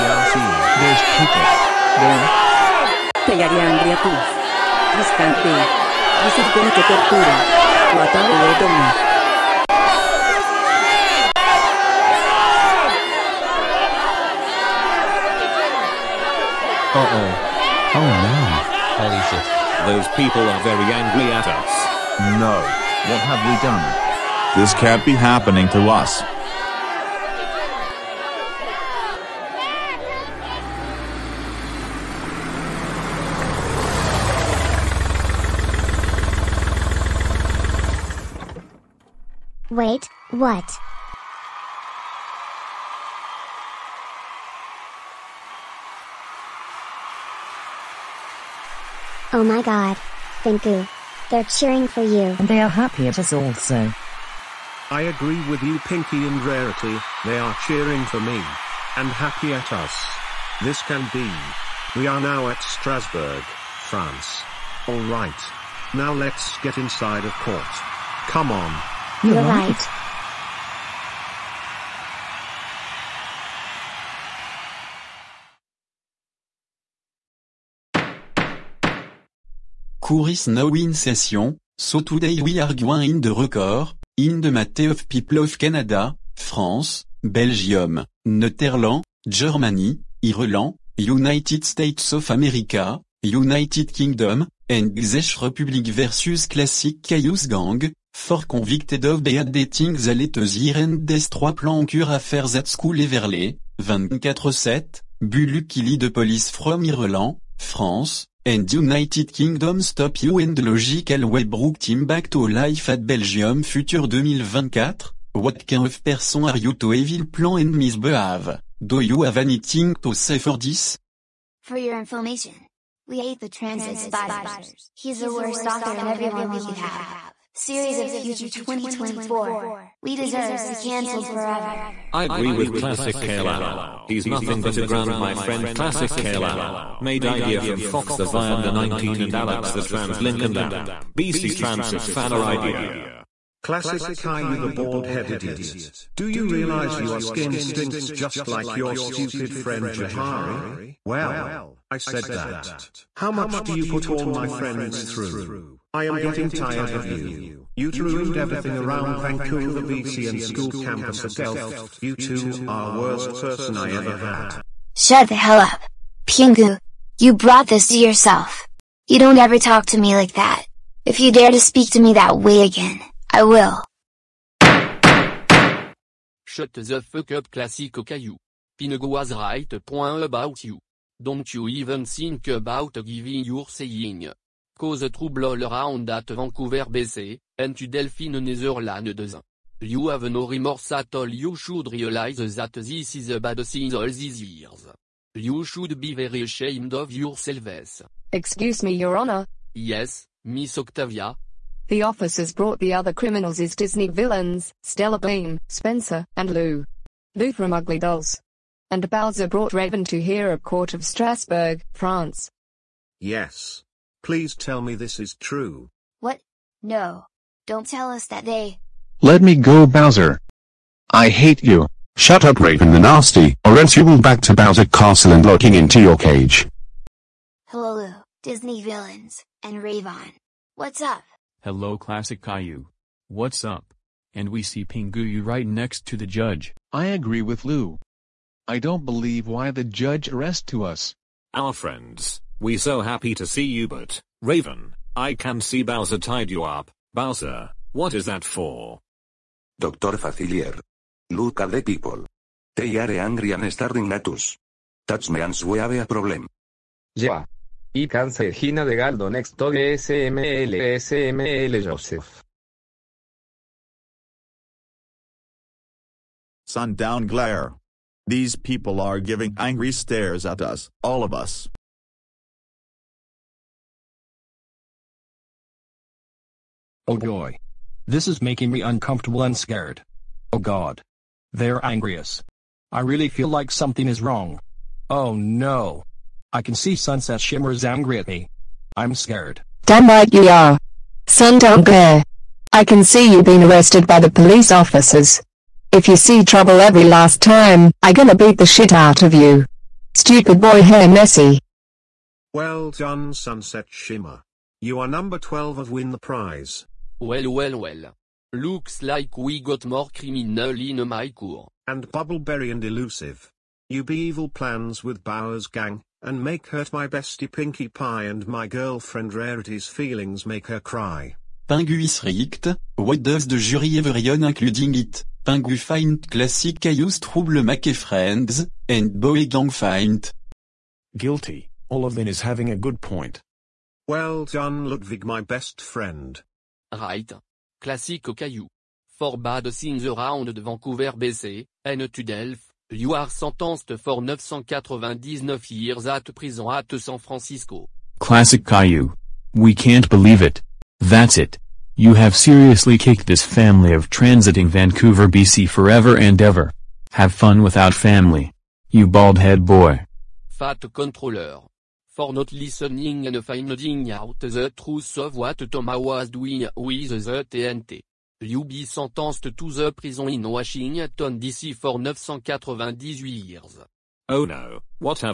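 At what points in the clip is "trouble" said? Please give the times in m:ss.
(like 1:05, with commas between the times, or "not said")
3:05, 4:56, 5:27.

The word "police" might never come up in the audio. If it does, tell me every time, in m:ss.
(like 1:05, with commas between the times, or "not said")
1:46, 4:54.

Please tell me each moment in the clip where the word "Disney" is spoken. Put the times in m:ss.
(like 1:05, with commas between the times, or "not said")
3:23, 3:48.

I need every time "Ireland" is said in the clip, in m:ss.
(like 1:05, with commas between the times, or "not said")
1:30, 1:46.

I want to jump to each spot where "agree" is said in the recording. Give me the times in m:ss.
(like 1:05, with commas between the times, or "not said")
0:55, 2:12, 3:57.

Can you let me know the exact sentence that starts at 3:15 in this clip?
You should be very ashamed of yourselves.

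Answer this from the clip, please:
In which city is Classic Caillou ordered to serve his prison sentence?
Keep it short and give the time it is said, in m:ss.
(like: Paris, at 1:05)
San Francisco, at 5:46.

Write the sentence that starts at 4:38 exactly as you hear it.
This is making me uncomfortable and scared.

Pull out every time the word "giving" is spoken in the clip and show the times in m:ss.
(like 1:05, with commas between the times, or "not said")
3:03, 4:29.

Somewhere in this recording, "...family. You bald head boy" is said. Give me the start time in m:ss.
5:57.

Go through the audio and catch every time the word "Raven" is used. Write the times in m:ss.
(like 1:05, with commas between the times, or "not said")
3:29, 3:42, 3:49, 4:04.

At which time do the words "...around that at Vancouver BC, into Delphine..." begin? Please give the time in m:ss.
3:05.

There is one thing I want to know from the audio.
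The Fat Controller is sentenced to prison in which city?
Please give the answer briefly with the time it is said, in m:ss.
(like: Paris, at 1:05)
Washington DC, at 6:10.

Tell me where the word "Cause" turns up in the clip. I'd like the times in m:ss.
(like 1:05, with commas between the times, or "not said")
3:04.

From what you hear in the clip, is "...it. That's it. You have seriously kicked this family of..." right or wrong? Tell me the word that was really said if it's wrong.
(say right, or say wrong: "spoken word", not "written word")
right.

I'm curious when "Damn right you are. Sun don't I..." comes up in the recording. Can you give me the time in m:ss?
4:49.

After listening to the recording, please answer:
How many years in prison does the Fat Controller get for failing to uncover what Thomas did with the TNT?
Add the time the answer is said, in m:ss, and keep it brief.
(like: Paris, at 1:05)
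998, at 6:11.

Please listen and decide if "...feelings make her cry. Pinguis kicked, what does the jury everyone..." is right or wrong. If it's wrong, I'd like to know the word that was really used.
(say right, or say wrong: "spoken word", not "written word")
wrong: "rigged", not "kicked".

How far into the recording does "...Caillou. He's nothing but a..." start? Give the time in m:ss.
2:13.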